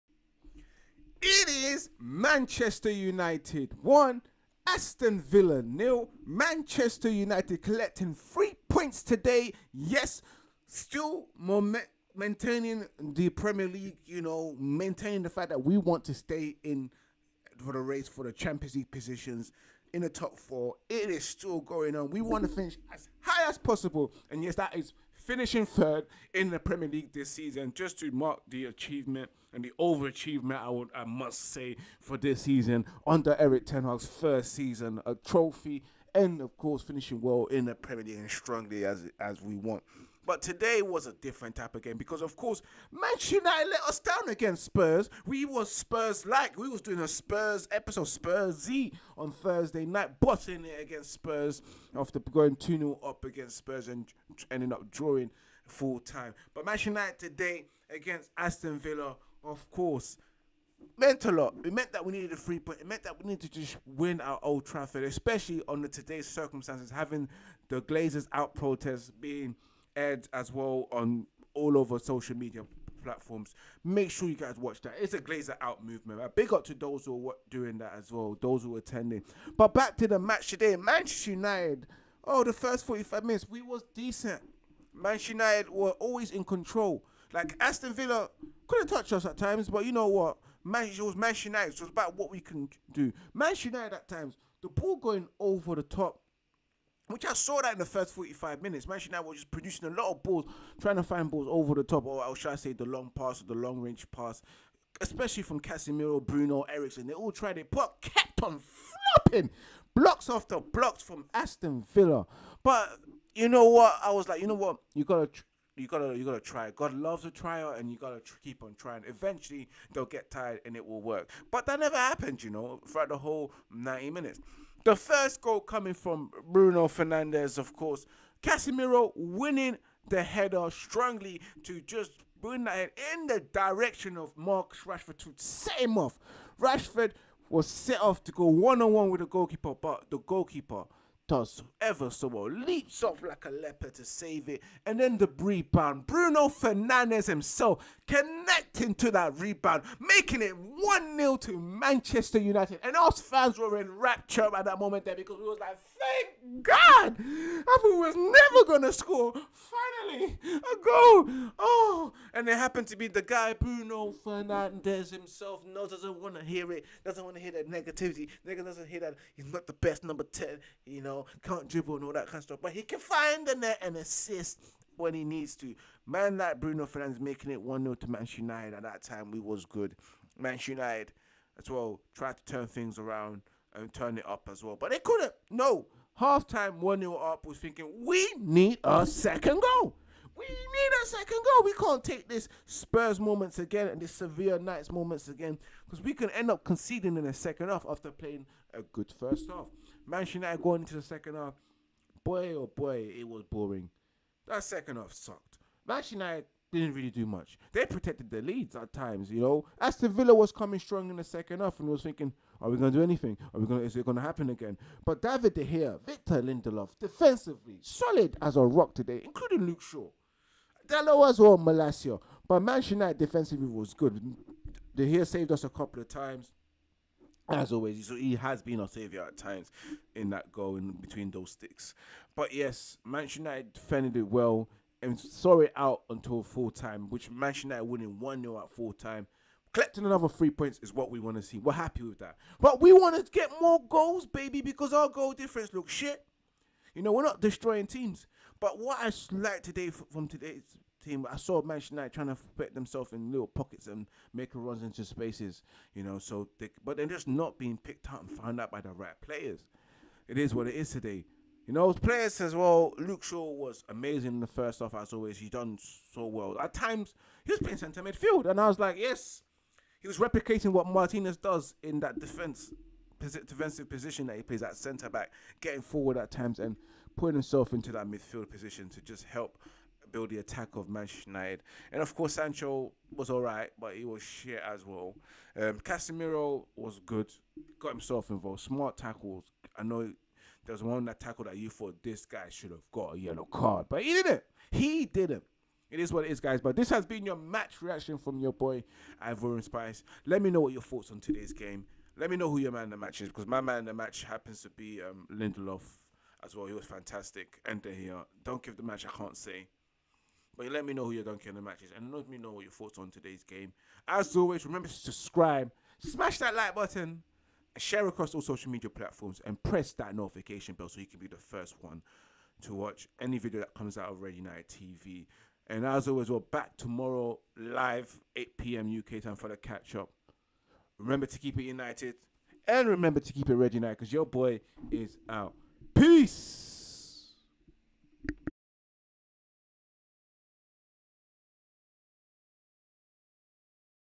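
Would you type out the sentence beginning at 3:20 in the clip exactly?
Manchester United going into the second half, boy oh boy, it was boring.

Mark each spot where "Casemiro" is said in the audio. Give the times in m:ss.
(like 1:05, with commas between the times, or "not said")
1:45, 2:08, 4:45.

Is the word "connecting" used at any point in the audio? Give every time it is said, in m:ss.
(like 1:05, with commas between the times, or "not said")
2:28.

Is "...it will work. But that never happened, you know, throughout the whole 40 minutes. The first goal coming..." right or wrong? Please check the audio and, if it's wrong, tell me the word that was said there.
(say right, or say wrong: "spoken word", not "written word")
wrong: "90", not "40".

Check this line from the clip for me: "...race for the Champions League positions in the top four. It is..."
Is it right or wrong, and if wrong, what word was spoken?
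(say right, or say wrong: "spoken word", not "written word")
right.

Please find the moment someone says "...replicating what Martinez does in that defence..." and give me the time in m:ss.
4:30.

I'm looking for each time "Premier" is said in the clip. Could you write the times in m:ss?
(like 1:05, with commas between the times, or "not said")
0:13, 0:26, 0:37.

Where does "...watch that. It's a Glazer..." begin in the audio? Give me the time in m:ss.
1:14.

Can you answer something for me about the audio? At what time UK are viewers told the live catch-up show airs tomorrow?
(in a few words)
8 p.m.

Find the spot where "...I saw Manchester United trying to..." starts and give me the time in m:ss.
4:11.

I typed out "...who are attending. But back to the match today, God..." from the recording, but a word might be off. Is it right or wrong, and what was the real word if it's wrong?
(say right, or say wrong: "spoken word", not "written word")
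wrong: "Manchester", not "God".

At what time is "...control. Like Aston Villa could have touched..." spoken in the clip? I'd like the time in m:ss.
1:26.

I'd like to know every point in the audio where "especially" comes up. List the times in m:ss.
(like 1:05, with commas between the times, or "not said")
1:05, 1:44.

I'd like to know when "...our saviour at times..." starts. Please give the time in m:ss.
3:48.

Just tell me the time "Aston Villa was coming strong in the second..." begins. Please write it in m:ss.
3:29.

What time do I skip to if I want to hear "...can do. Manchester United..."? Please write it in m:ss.
1:32.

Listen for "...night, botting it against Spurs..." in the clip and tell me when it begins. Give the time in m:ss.
0:49.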